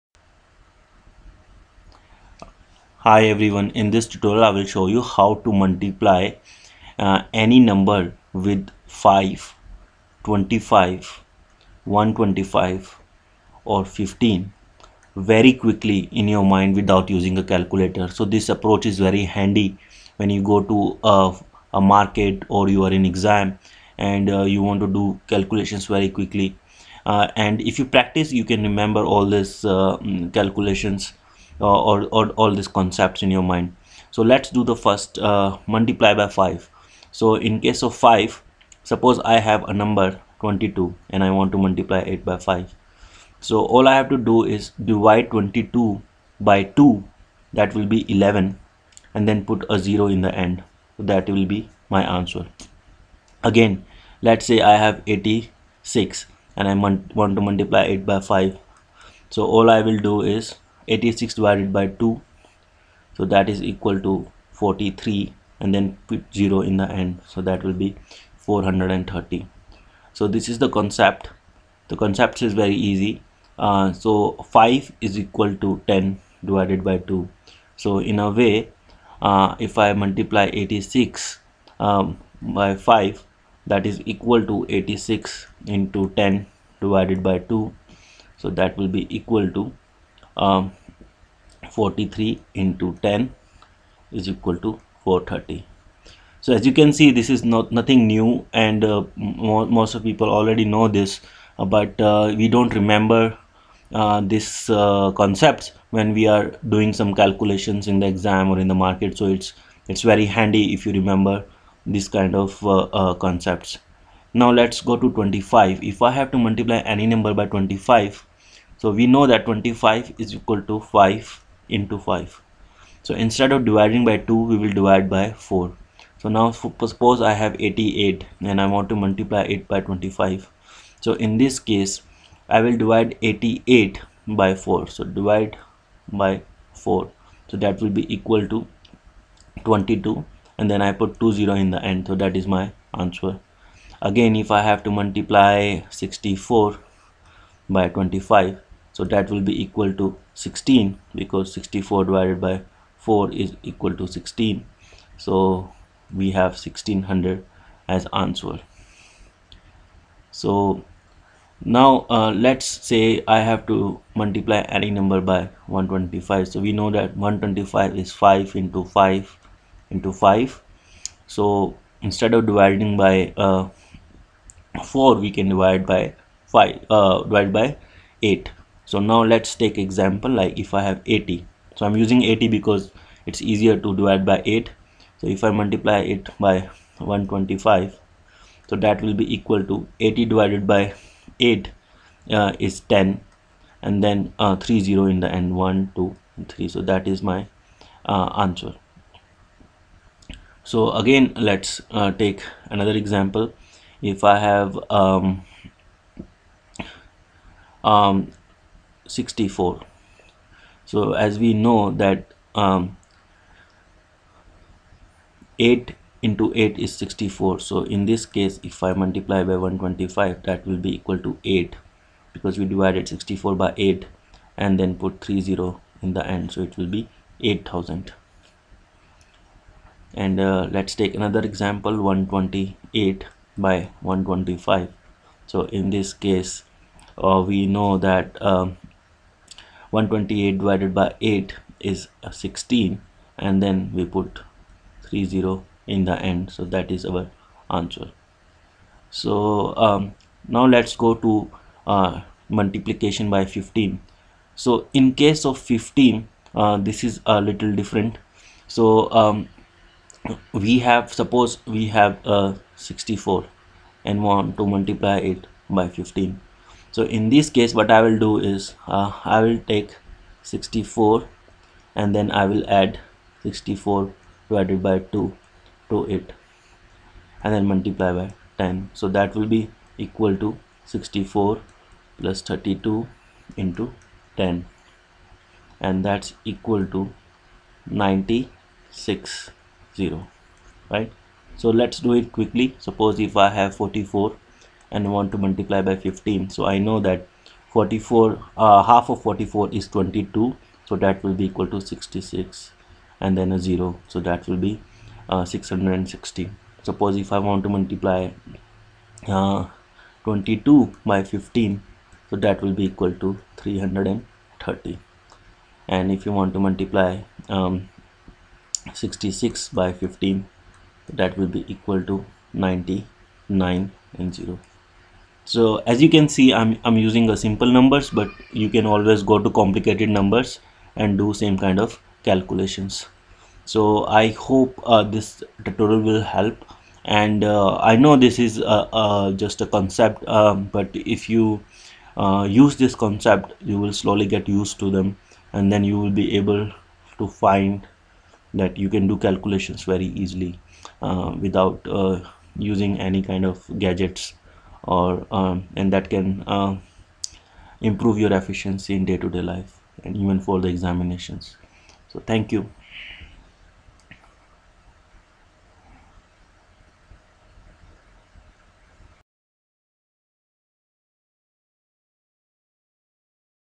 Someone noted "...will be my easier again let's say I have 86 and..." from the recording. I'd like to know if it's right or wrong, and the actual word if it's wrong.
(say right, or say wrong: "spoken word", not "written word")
wrong: "answer", not "easier".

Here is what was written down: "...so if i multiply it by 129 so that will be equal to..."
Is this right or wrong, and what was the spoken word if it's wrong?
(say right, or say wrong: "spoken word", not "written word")
wrong: "125", not "129".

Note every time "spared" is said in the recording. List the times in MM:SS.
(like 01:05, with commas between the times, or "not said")
not said.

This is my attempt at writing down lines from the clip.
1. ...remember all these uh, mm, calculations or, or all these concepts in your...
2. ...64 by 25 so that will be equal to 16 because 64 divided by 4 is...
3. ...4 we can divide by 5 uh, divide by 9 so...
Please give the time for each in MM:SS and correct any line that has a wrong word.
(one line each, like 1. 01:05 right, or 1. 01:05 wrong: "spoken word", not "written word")
1. 00:28 right
2. 02:25 right
3. 02:54 wrong: "8", not "9".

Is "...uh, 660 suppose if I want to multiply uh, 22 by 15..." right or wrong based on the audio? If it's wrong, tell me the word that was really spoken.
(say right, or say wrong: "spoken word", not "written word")
right.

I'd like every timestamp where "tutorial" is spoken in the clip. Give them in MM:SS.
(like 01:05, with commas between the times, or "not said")
00:04, 05:35.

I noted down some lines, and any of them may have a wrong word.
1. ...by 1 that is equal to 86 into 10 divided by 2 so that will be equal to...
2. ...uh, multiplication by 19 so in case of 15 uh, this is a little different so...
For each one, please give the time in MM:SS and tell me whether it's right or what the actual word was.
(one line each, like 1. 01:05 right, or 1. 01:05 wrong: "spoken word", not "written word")
1. 01:22 wrong: "5", not "1"
2. 04:11 wrong: "15", not "19".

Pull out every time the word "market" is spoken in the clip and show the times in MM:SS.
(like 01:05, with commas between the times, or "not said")
00:21, 01:48.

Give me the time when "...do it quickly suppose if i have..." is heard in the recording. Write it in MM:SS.
04:51.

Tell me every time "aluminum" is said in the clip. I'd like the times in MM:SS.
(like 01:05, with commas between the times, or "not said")
not said.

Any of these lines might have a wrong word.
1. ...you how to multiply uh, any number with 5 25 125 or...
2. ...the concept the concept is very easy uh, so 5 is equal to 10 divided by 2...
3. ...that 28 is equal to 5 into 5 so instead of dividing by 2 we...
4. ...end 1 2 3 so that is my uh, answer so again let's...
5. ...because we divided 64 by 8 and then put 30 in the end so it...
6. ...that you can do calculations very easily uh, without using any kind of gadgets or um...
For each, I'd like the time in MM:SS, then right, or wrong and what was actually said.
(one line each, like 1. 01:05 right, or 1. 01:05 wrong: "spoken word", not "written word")
1. 00:04 right
2. 01:10 right
3. 01:59 wrong: "25", not "28"
4. 03:15 right
5. 03:42 right
6. 05:48 right.